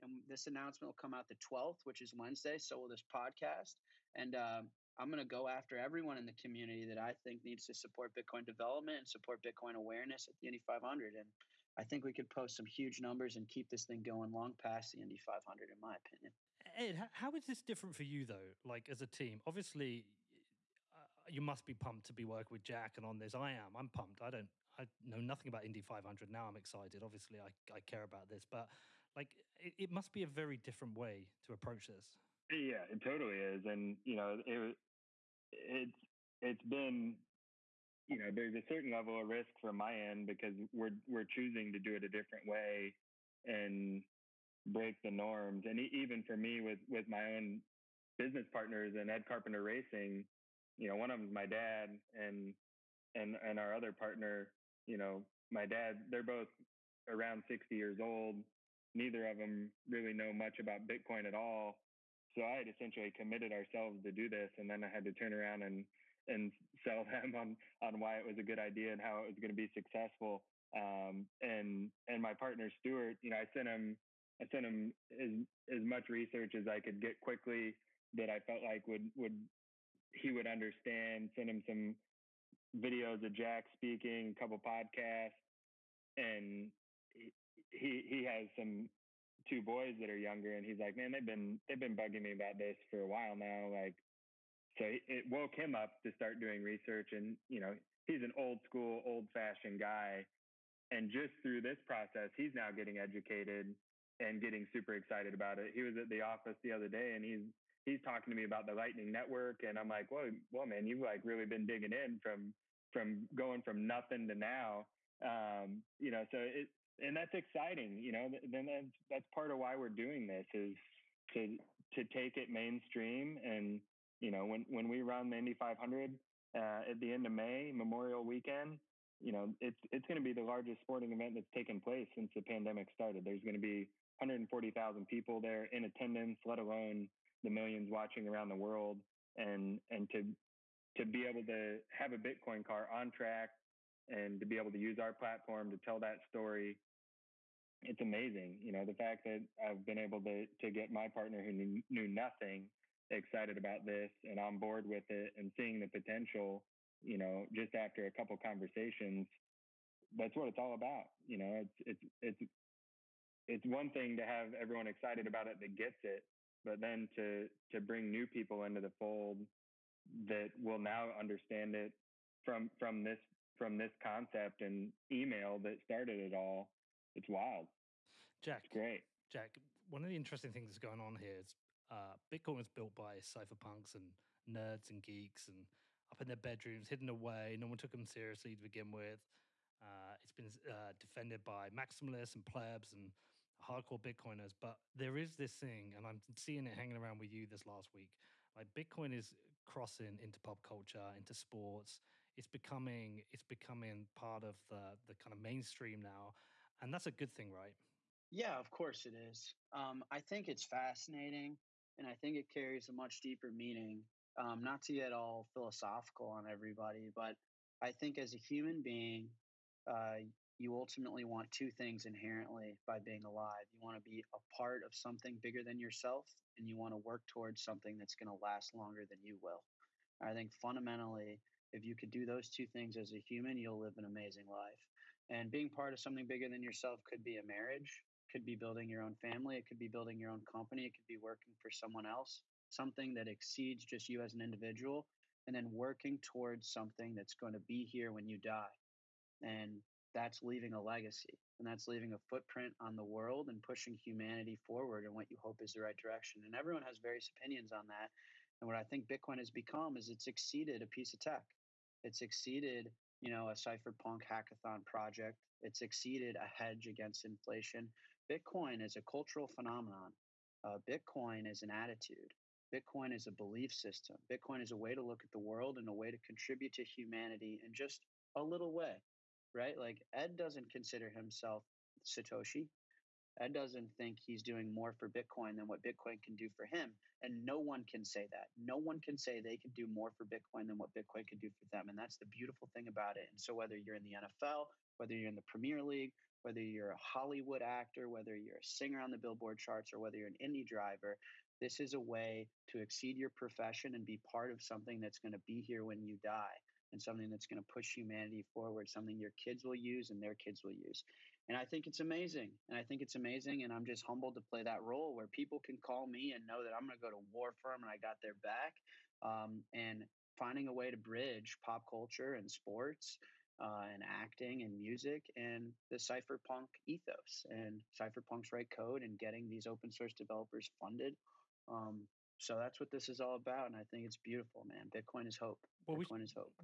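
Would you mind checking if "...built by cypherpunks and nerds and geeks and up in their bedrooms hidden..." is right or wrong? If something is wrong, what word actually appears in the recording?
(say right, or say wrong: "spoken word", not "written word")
right.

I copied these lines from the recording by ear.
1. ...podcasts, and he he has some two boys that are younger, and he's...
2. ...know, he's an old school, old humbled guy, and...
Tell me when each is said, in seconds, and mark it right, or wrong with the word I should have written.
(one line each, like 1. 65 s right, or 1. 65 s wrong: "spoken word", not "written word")
1. 84 s right
2. 97 s wrong: "fashioned", not "humbled".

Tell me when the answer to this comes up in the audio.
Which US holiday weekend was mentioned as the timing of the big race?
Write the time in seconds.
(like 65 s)
127 s.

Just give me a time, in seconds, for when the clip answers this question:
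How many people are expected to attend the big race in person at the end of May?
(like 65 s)
134 s.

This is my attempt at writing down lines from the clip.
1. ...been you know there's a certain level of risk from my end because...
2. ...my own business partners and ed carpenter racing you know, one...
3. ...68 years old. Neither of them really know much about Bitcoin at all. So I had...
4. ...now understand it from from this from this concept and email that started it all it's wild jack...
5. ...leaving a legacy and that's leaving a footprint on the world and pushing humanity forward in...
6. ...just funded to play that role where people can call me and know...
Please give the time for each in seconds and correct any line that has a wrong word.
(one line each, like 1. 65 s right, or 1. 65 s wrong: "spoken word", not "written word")
1. 36 s right
2. 47 s right
3. 57 s wrong: "60", not "68"
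4. 170 s right
5. 250 s right
6. 313 s wrong: "humbled", not "funded".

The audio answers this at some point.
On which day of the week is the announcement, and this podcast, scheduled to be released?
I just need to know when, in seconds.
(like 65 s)
2 s.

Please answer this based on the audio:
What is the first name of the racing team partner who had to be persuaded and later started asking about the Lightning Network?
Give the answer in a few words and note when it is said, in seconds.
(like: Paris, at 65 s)
Stuart, at 72 s.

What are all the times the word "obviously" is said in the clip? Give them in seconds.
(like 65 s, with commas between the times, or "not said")
19 s, 27 s.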